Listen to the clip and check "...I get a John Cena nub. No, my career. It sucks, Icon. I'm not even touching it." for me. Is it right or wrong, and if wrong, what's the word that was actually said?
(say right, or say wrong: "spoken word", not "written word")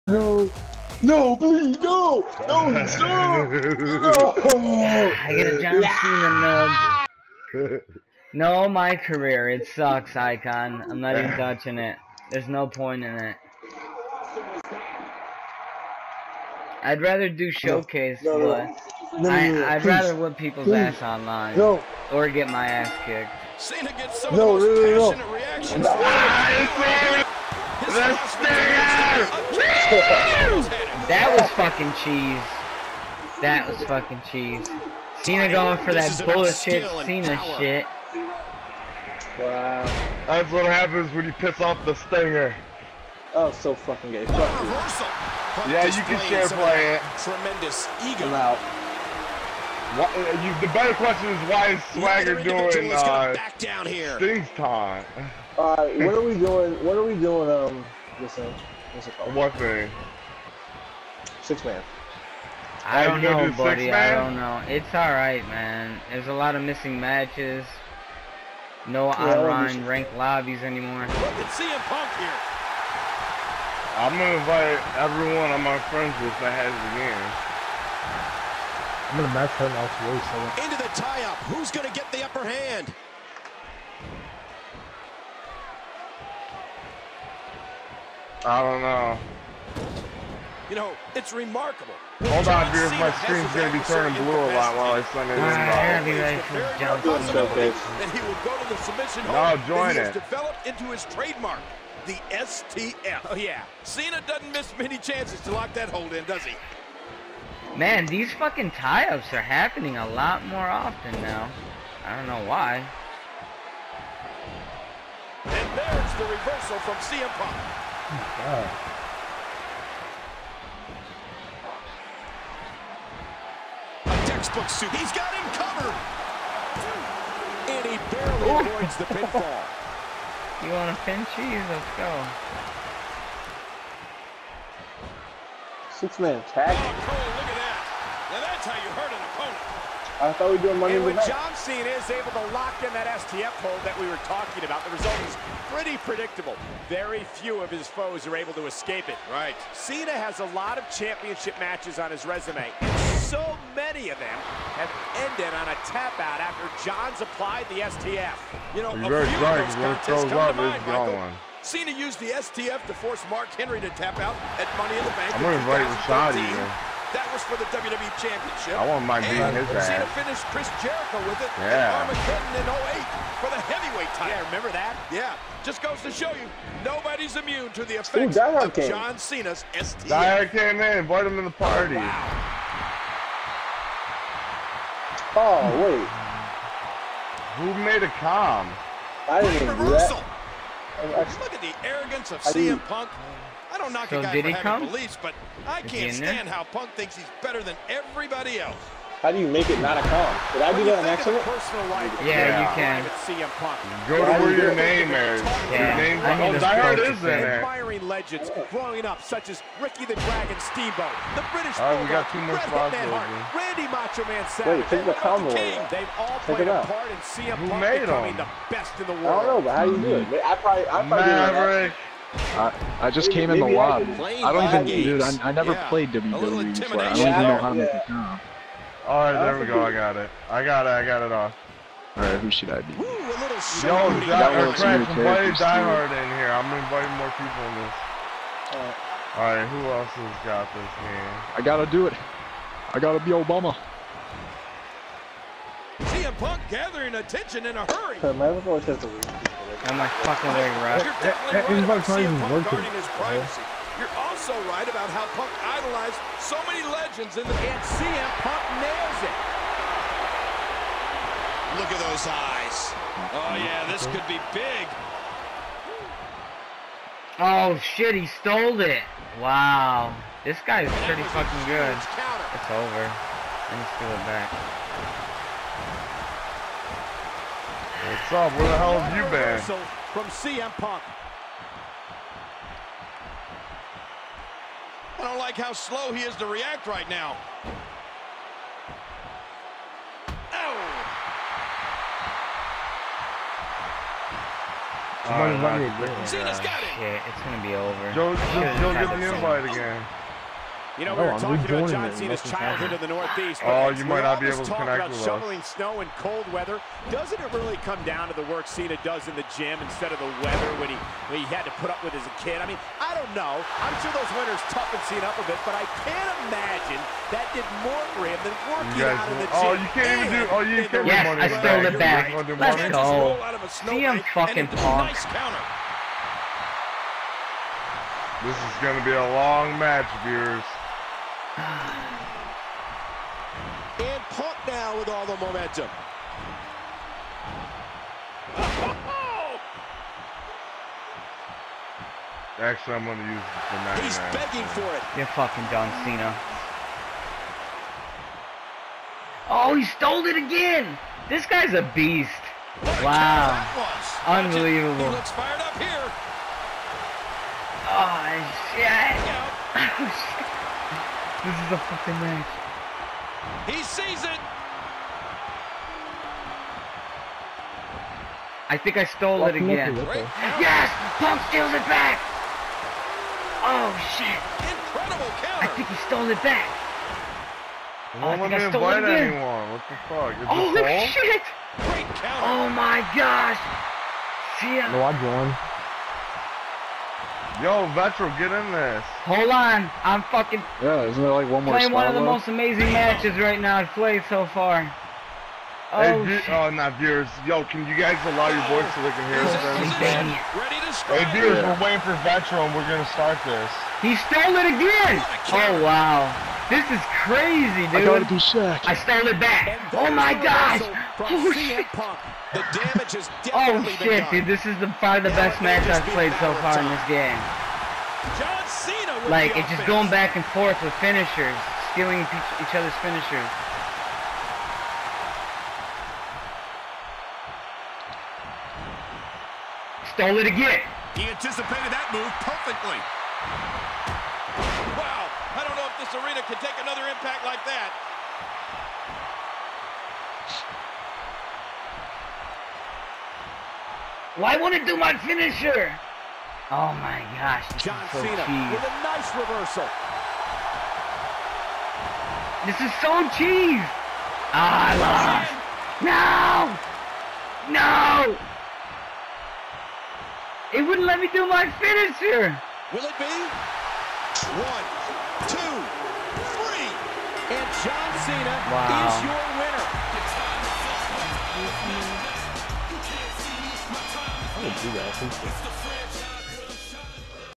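right.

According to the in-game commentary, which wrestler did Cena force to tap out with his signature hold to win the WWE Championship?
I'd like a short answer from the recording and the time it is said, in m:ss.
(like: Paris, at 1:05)
Mark Henry, at 2:43.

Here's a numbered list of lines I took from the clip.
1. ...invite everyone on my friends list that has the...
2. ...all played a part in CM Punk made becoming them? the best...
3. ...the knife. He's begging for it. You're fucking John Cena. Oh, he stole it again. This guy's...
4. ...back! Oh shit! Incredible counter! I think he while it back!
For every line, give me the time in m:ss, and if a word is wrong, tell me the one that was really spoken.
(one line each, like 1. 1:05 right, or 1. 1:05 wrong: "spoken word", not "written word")
1. 1:14 right
2. 3:36 right
3. 5:43 right
4. 6:11 wrong: "stole", not "while".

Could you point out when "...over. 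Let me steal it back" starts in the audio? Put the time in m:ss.
4:32.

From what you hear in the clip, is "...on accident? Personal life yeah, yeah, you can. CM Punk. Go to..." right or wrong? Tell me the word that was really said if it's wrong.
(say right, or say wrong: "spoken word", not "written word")
right.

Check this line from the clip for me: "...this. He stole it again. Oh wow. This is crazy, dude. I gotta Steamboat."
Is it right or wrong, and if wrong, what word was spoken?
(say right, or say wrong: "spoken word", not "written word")
wrong: "Shaq", not "Steamboat".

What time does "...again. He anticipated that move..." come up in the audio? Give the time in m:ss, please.
7:10.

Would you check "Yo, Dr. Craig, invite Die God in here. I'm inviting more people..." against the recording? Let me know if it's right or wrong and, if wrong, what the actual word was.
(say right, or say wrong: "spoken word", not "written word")
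wrong: "Hard", not "God".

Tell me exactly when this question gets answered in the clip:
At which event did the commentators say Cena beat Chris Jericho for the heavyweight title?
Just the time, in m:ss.
2:51.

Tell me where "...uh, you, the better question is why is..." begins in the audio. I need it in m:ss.
0:50.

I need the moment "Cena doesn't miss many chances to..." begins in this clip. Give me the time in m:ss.
1:43.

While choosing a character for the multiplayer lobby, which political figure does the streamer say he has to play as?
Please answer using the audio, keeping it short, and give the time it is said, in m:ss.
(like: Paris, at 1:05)
Obama, at 4:03.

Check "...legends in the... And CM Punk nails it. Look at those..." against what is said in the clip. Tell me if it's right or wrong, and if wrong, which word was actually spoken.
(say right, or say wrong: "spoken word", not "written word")
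right.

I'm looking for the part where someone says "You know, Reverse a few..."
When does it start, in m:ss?
2:38.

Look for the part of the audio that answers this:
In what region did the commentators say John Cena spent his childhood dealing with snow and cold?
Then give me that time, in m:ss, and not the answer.
5:02.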